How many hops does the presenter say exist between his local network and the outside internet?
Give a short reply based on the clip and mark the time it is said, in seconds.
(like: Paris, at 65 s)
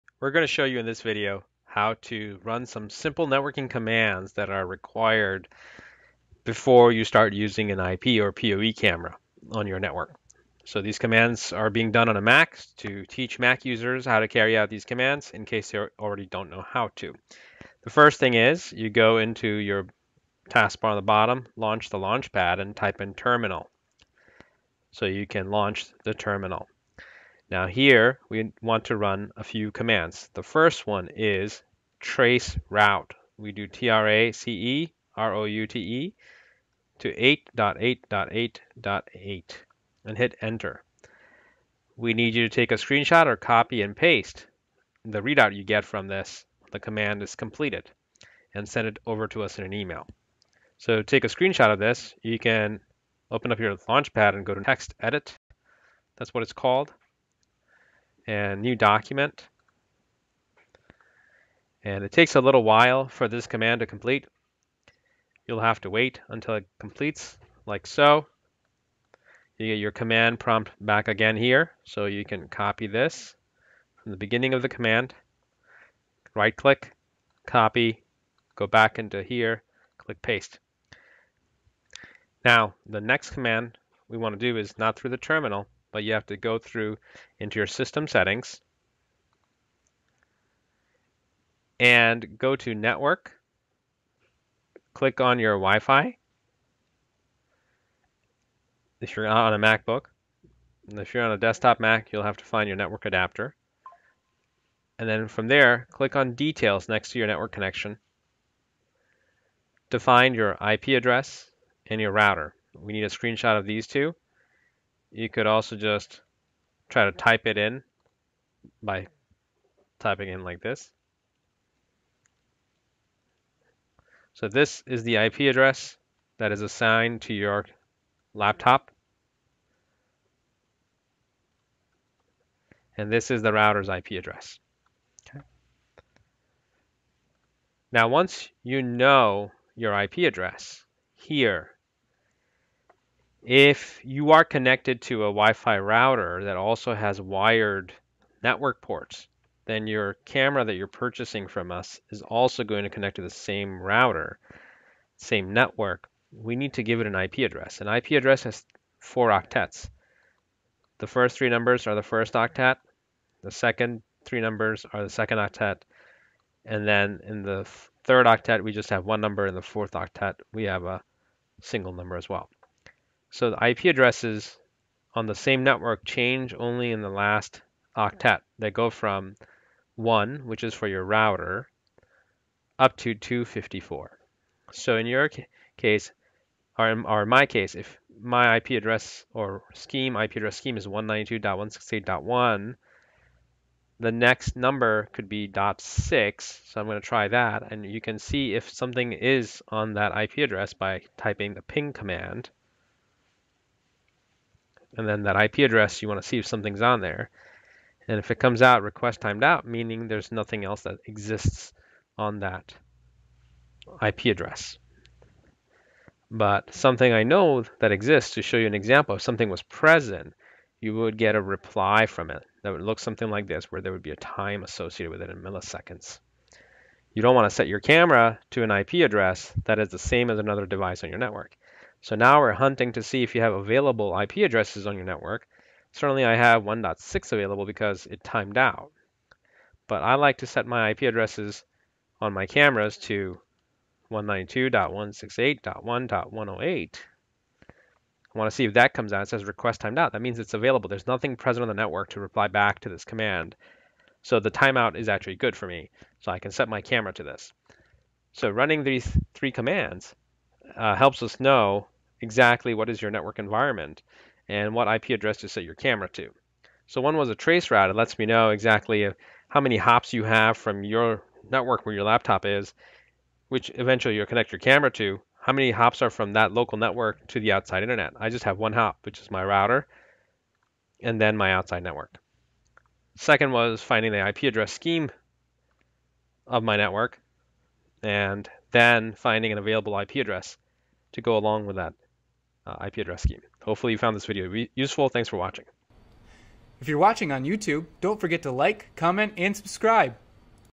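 1, at 278 s.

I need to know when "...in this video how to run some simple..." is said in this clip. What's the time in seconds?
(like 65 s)
0 s.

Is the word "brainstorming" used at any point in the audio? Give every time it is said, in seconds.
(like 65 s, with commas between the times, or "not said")
not said.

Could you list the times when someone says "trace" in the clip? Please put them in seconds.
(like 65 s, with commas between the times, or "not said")
31 s, 267 s.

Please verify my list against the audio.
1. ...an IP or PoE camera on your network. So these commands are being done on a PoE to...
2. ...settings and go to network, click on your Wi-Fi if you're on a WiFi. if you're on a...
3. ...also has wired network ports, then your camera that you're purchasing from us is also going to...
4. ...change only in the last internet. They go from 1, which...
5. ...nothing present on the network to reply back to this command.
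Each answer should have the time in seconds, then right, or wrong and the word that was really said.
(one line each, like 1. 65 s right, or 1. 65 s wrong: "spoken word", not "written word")
1. 7 s wrong: "Mac", not "PoE"
2. 88 s wrong: "MacBook", not "WiFi"
3. 146 s right
4. 176 s wrong: "octet", not "internet"
5. 251 s right.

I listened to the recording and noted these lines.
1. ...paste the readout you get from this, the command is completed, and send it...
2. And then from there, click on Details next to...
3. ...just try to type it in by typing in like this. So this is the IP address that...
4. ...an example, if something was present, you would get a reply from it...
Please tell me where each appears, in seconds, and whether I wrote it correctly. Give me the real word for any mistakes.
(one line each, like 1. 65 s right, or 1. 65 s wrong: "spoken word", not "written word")
1. 43 s right
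2. 104 s right
3. 115 s right
4. 218 s right.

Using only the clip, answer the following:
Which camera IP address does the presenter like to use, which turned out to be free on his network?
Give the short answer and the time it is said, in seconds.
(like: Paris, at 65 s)
192.168.1.108, at 244 s.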